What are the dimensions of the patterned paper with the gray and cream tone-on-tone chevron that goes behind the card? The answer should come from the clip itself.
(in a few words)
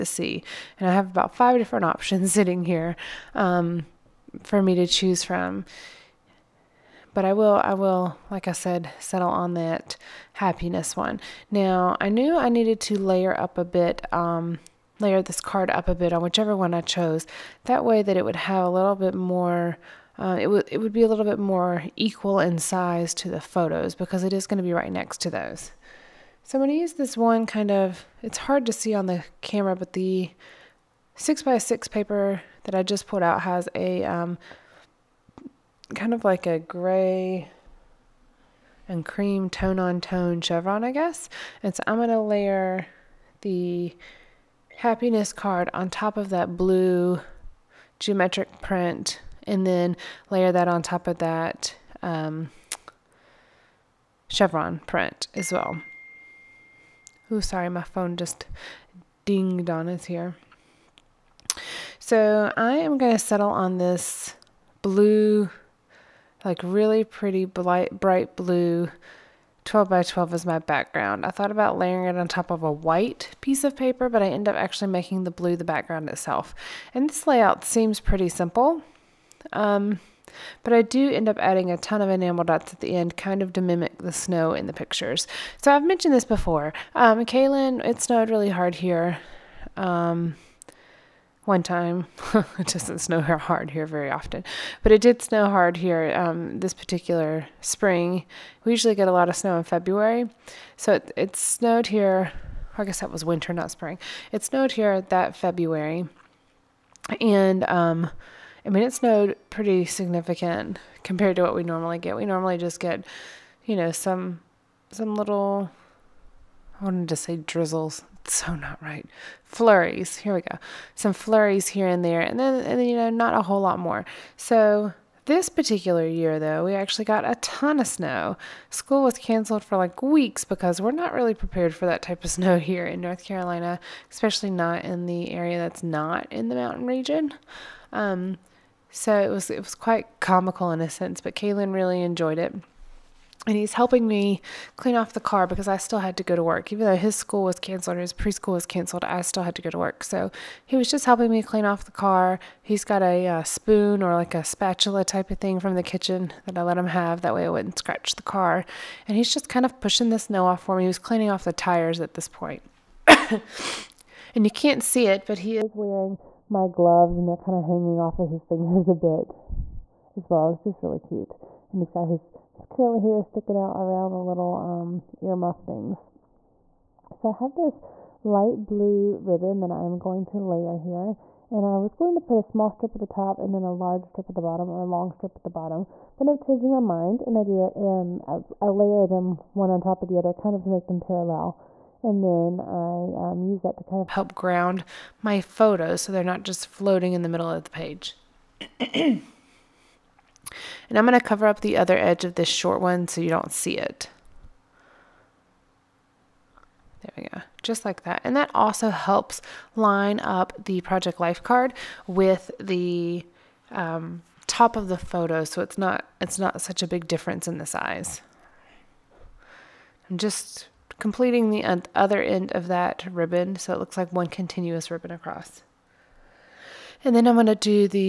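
6 by 6.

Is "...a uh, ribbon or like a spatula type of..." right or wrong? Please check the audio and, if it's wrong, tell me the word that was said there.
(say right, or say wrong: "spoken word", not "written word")
wrong: "spoon", not "ribbon".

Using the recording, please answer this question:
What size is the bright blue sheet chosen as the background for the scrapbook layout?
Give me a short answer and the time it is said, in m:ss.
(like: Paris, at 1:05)
12 by 12, at 1:09.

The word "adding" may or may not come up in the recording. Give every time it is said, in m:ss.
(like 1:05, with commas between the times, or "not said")
1:21.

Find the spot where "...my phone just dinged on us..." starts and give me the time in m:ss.
0:57.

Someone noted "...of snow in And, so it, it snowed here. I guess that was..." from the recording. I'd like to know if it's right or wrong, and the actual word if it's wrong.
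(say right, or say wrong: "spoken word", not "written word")
wrong: "February", not "And".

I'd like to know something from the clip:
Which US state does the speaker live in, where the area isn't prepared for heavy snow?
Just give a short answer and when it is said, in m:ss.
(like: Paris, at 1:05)
North Carolina, at 2:13.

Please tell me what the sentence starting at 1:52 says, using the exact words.
We normally just get, you know, some some little.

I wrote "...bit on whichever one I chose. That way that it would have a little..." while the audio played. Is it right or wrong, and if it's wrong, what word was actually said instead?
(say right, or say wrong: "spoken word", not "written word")
right.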